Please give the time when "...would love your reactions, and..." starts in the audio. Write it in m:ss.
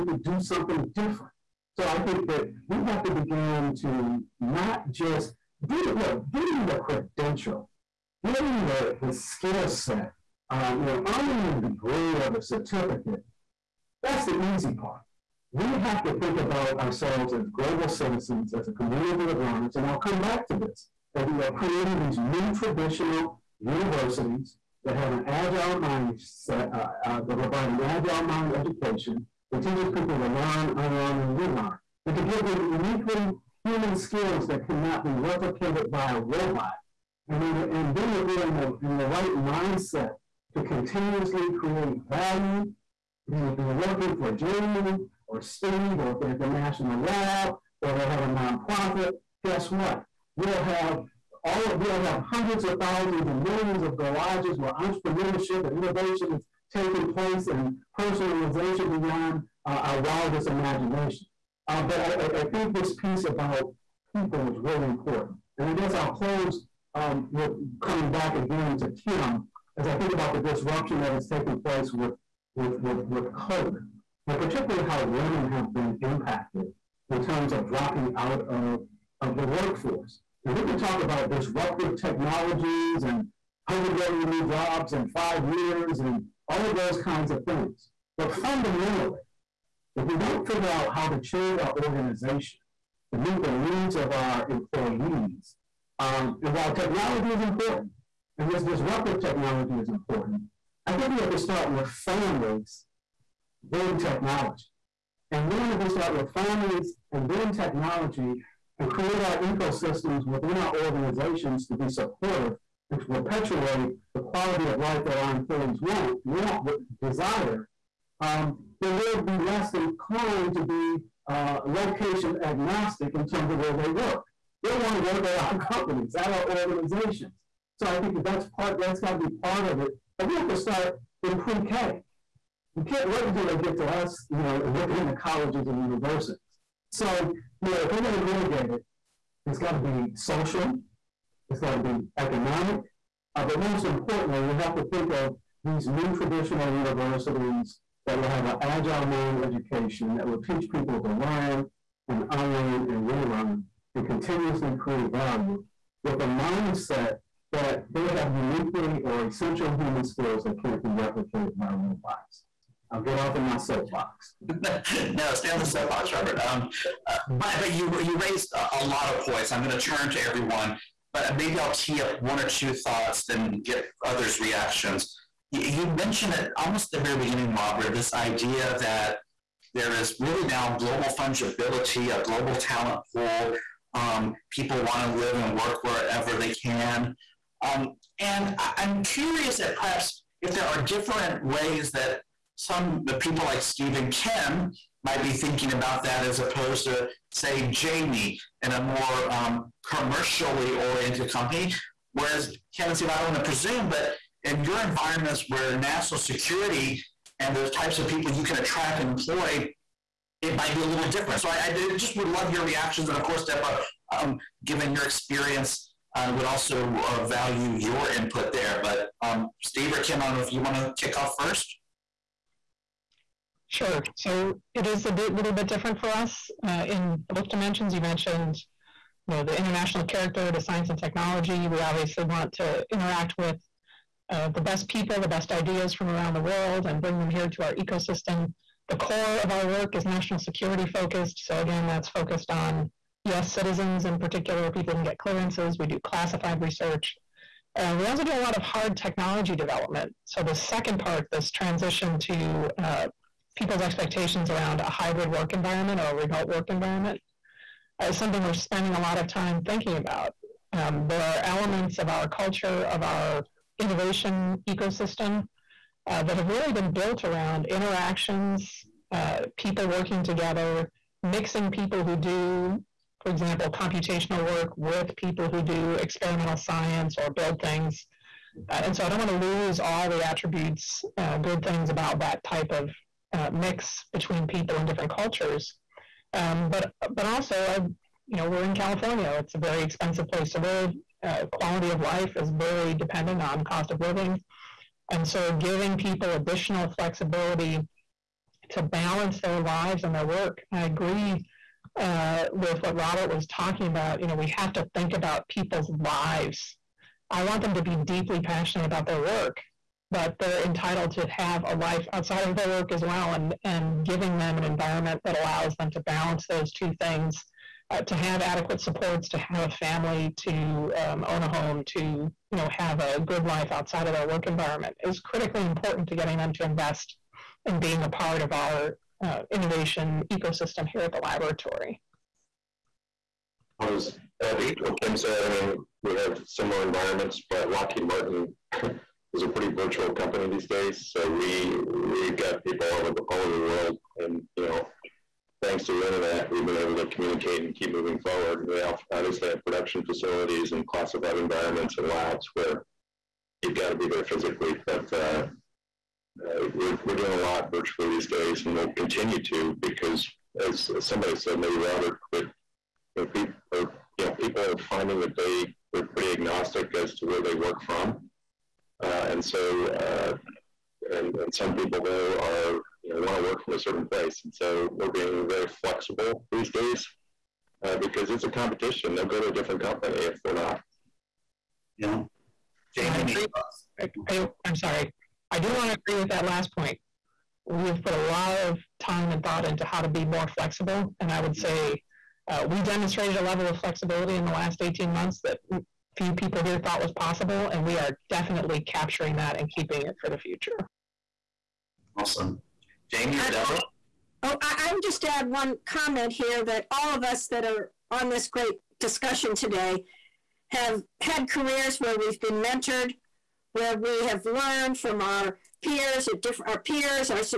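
3:32.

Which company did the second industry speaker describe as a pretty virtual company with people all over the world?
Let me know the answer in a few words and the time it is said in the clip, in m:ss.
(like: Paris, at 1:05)
Lockheed Martin, at 5:37.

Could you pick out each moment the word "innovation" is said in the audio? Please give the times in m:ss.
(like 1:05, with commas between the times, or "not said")
0:55, 4:23, 5:29.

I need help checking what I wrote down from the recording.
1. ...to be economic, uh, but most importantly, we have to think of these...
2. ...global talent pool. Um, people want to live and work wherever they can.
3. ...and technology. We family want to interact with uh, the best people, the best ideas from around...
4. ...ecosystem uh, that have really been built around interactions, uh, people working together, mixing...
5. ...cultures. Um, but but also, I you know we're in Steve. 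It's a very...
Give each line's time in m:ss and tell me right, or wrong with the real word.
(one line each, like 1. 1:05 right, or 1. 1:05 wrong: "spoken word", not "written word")
1. 2:21 right
2. 3:02 right
3. 3:50 wrong: "obviously", not "family"
4. 4:24 right
5. 4:45 wrong: "California", not "Steve".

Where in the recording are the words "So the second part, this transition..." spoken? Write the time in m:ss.
4:10.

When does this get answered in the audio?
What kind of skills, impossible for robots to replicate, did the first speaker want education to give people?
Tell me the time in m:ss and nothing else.
0:32.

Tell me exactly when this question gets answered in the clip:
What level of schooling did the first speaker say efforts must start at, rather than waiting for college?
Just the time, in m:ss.
2:11.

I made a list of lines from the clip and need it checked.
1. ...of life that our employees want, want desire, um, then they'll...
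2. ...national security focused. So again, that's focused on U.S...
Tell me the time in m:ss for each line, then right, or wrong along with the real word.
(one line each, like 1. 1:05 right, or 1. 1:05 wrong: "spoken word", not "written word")
1. 1:54 right
2. 4:00 right.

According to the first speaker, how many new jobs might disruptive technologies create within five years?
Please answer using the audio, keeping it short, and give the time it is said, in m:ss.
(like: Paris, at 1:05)
100 million, at 1:23.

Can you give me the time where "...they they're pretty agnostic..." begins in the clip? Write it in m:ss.
6:05.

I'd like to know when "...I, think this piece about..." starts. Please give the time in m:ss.
1:02.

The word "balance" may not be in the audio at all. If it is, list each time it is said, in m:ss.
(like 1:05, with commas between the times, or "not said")
4:58, 5:16.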